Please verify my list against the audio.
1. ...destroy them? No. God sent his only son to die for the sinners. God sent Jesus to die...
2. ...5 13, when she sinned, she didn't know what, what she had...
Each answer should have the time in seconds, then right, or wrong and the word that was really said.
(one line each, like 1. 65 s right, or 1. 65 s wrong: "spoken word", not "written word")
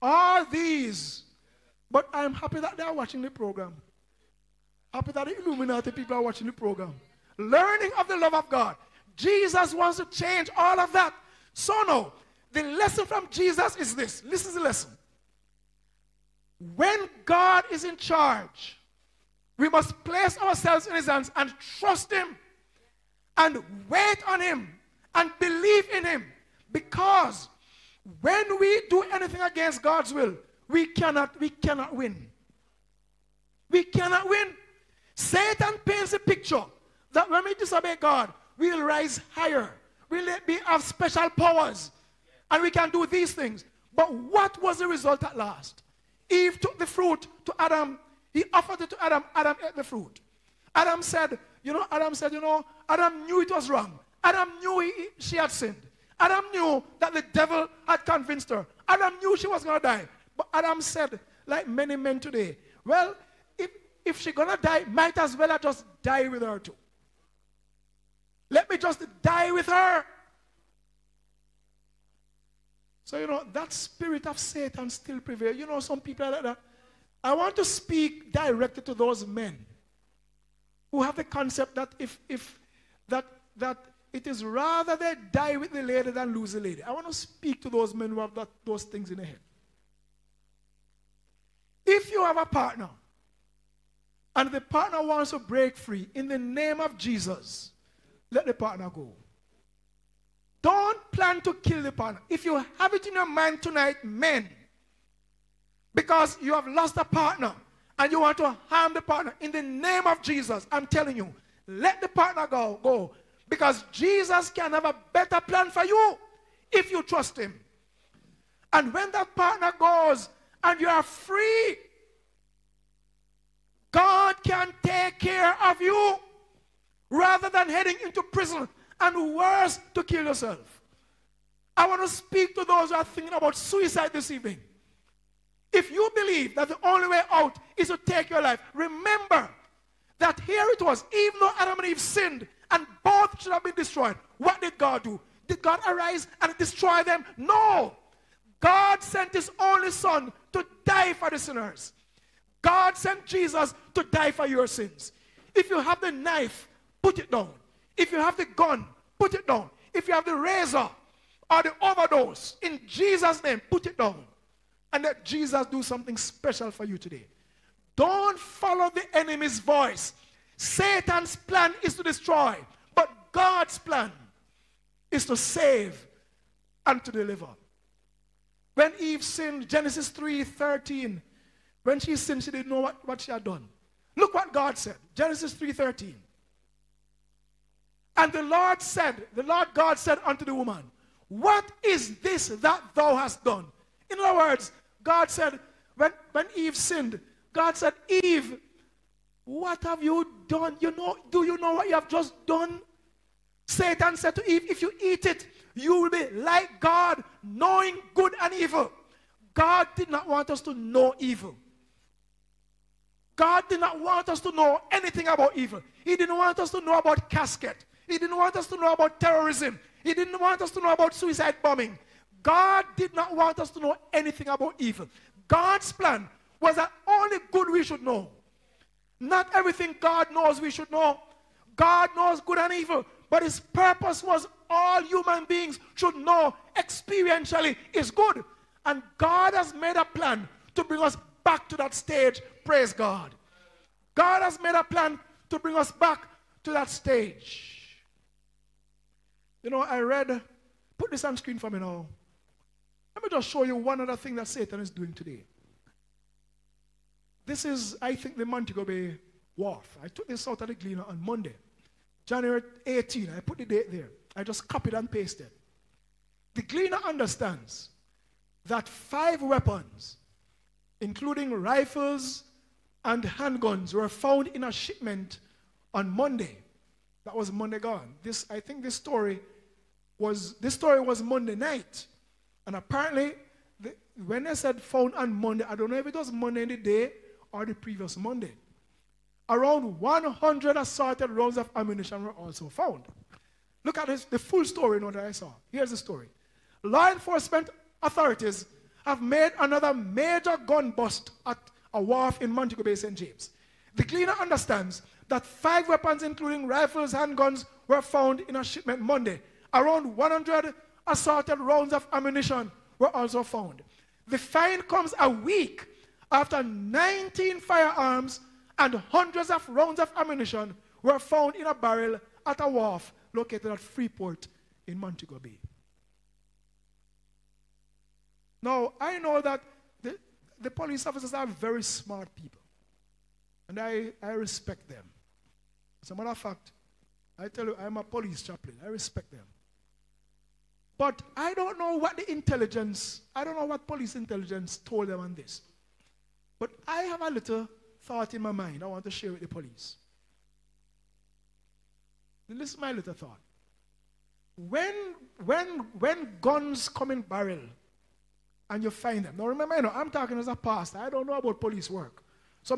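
1. 146 s right
2. 180 s wrong: "3", not "5".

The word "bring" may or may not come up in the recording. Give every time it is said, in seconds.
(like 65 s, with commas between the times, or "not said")
240 s, 245 s.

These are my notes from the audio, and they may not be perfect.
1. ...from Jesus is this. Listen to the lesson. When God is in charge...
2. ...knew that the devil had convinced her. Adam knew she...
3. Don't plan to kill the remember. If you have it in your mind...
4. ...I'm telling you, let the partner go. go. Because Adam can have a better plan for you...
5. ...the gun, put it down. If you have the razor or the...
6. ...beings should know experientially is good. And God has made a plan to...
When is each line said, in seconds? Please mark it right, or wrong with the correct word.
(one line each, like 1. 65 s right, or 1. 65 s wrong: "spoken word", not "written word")
1. 13 s right
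2. 56 s right
3. 100 s wrong: "partner", not "remember"
4. 110 s wrong: "Jesus", not "Adam"
5. 158 s right
6. 235 s right.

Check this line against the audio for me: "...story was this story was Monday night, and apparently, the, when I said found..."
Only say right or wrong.
right.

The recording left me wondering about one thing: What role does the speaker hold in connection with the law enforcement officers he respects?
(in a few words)
Police chaplain.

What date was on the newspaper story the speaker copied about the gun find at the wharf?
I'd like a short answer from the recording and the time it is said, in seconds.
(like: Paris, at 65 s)
January 18, at 262 s.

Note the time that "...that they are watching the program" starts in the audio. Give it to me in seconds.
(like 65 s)
2 s.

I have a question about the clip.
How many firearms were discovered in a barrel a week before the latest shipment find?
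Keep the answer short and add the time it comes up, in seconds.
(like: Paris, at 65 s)
19, at 316 s.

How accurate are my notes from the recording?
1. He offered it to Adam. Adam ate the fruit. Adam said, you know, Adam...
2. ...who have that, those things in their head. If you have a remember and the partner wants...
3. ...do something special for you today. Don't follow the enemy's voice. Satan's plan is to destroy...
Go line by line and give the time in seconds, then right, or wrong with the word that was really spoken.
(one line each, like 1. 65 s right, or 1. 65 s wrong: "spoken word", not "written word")
1. 48 s right
2. 88 s wrong: "partner", not "remember"
3. 165 s right.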